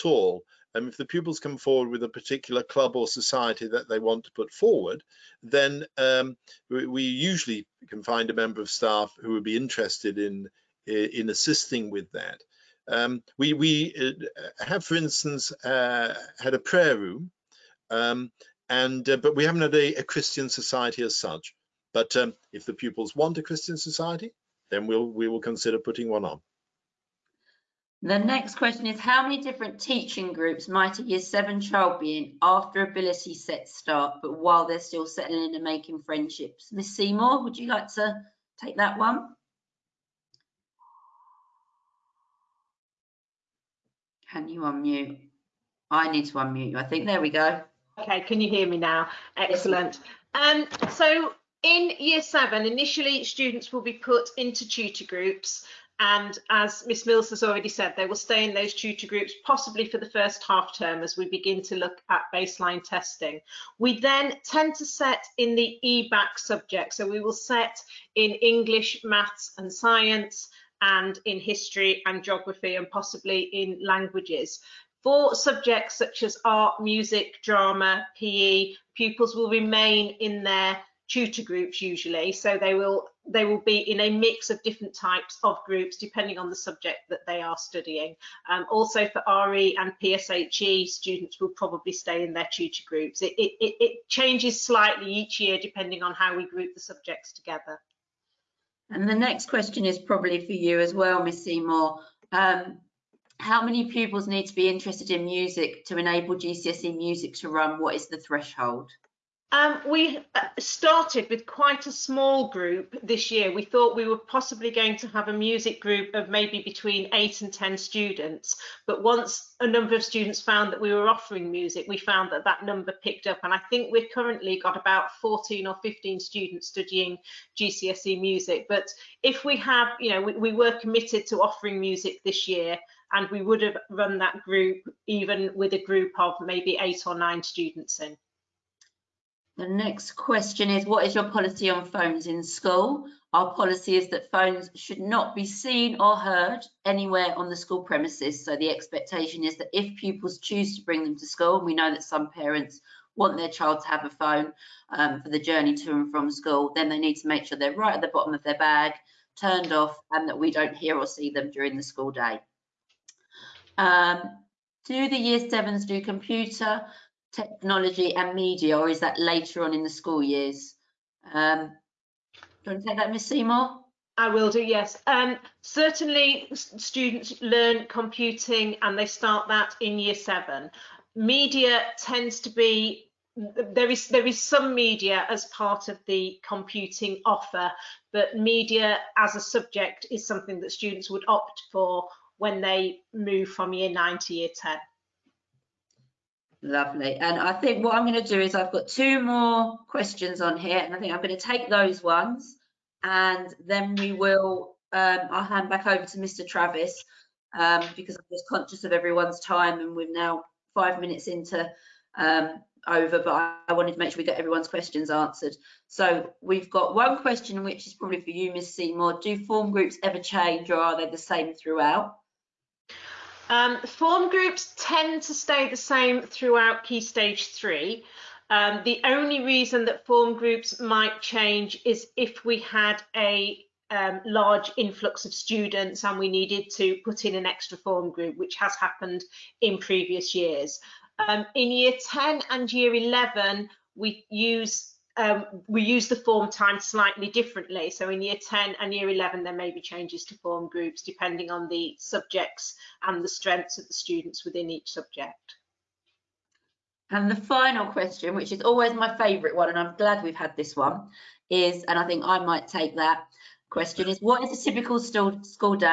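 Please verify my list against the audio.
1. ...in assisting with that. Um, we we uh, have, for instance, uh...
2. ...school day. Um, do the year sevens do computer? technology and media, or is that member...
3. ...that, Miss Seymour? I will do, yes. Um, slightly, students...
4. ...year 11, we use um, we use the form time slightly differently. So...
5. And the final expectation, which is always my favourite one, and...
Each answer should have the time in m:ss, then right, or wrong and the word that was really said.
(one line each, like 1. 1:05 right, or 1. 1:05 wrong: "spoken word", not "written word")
1. 0:10 right
2. 2:41 wrong: "later", not "member"
3. 2:52 wrong: "certainly", not "slightly"
4. 4:02 right
5. 4:17 wrong: "question", not "expectation".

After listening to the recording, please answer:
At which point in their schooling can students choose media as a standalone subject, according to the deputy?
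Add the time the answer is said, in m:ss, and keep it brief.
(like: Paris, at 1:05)
year nine to year ten, at 3:13.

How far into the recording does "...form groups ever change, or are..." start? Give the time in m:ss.
3:39.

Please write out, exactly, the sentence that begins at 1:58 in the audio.
But once a number of students found that we were offering music, we found that that number picked up.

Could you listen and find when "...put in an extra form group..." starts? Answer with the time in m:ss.
3:57.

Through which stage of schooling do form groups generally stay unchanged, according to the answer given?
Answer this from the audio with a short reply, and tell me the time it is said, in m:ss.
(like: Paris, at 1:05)
key stage three, at 3:46.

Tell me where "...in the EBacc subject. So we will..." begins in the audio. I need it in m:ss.
1:05.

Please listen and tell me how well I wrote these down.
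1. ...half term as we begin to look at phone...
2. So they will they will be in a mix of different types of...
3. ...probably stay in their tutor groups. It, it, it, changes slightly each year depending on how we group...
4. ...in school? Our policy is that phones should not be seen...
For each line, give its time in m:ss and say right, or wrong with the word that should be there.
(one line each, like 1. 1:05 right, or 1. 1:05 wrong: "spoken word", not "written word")
1. 1:00 wrong: "baseline", not "phone"
2. 1:22 right
3. 1:31 right
4. 2:22 right.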